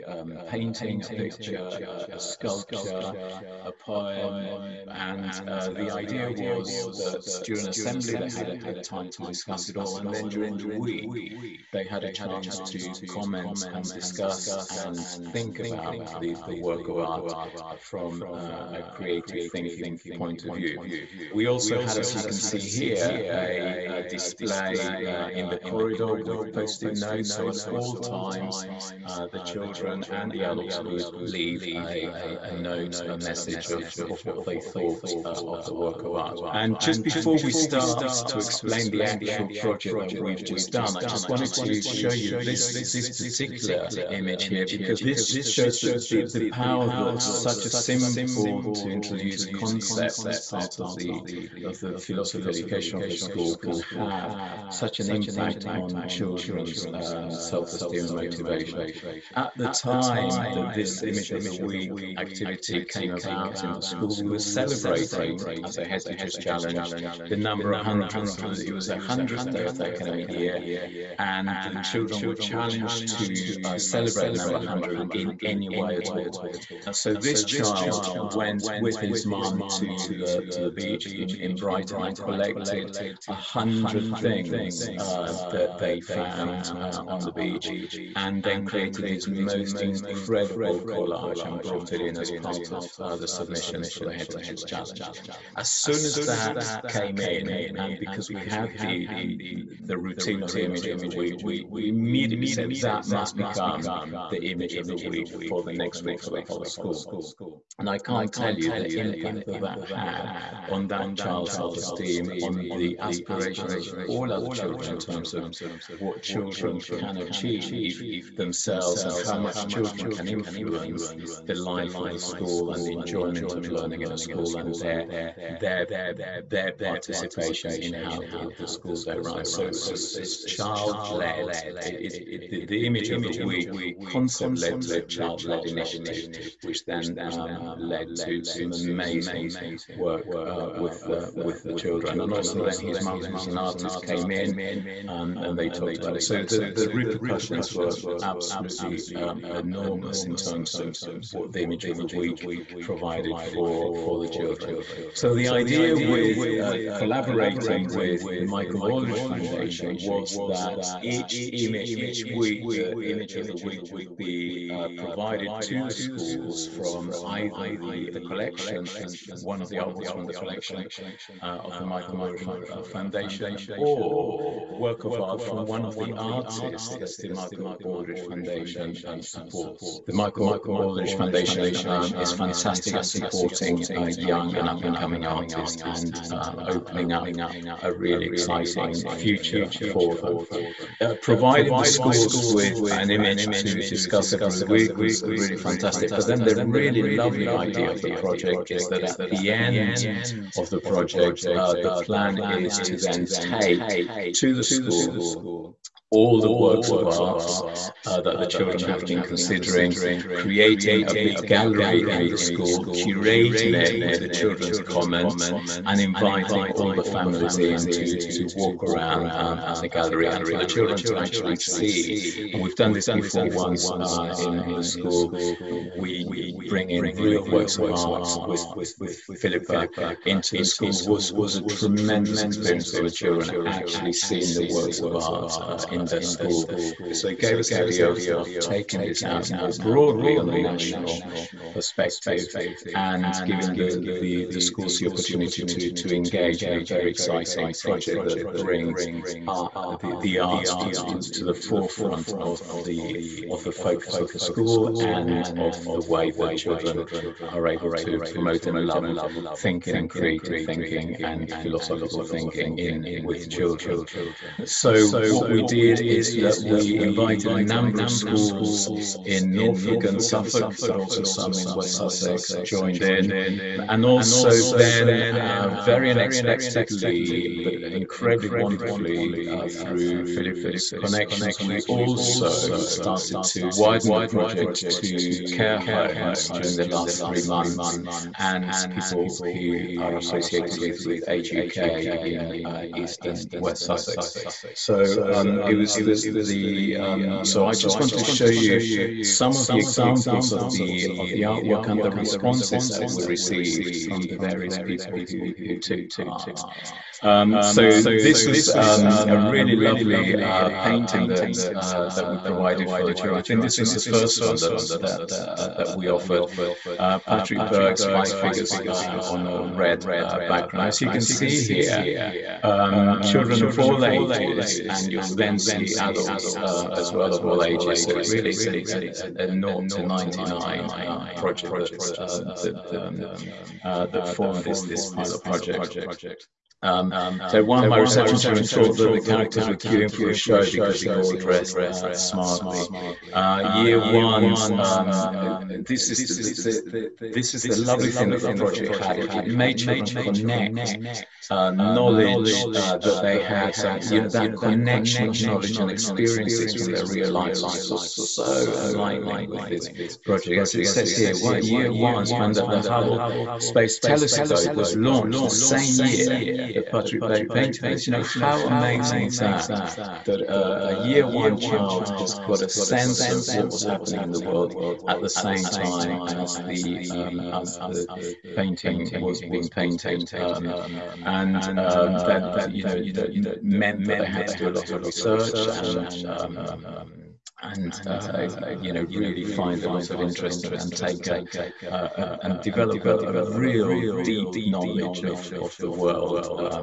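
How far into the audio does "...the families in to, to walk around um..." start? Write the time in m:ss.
3:36.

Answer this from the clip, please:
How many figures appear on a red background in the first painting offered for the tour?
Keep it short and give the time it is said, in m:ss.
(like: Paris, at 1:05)
5, at 5:18.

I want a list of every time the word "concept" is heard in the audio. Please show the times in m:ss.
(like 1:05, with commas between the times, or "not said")
0:49, 2:14.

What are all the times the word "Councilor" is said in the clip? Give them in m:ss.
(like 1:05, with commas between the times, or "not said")
not said.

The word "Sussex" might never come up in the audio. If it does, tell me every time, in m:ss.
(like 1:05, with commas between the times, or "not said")
4:31, 4:53.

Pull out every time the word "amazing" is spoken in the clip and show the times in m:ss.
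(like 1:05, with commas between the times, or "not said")
2:18, 6:08.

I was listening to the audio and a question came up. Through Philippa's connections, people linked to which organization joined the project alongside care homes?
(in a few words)
Age UK.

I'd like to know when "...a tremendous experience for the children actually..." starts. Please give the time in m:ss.
3:51.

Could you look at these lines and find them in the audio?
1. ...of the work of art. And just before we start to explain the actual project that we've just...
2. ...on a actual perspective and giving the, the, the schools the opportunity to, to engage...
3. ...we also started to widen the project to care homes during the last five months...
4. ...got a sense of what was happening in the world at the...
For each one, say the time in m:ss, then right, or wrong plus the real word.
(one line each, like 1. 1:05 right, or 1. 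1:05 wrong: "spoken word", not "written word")
1. 0:35 right
2. 4:00 wrong: "national", not "actual"
3. 4:41 wrong: "three", not "five"
4. 6:12 right.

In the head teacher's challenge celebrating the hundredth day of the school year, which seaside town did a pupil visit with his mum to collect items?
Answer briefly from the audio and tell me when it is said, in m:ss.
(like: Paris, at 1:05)
Brighton, at 1:21.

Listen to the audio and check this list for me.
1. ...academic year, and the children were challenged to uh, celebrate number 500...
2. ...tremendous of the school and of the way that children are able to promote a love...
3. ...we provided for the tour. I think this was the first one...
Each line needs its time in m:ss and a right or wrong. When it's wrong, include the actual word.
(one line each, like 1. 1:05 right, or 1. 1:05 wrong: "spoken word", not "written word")
1. 1:09 wrong: "100", not "500"
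2. 4:13 wrong: "focus", not "tremendous"
3. 5:12 right.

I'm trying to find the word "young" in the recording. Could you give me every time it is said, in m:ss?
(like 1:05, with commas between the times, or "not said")
3:04.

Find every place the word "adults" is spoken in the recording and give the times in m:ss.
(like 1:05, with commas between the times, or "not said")
0:30, 5:25.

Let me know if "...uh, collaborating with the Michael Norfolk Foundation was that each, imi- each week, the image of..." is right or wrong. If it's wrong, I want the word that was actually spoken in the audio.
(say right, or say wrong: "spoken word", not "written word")
wrong: "Aldrich", not "Norfolk".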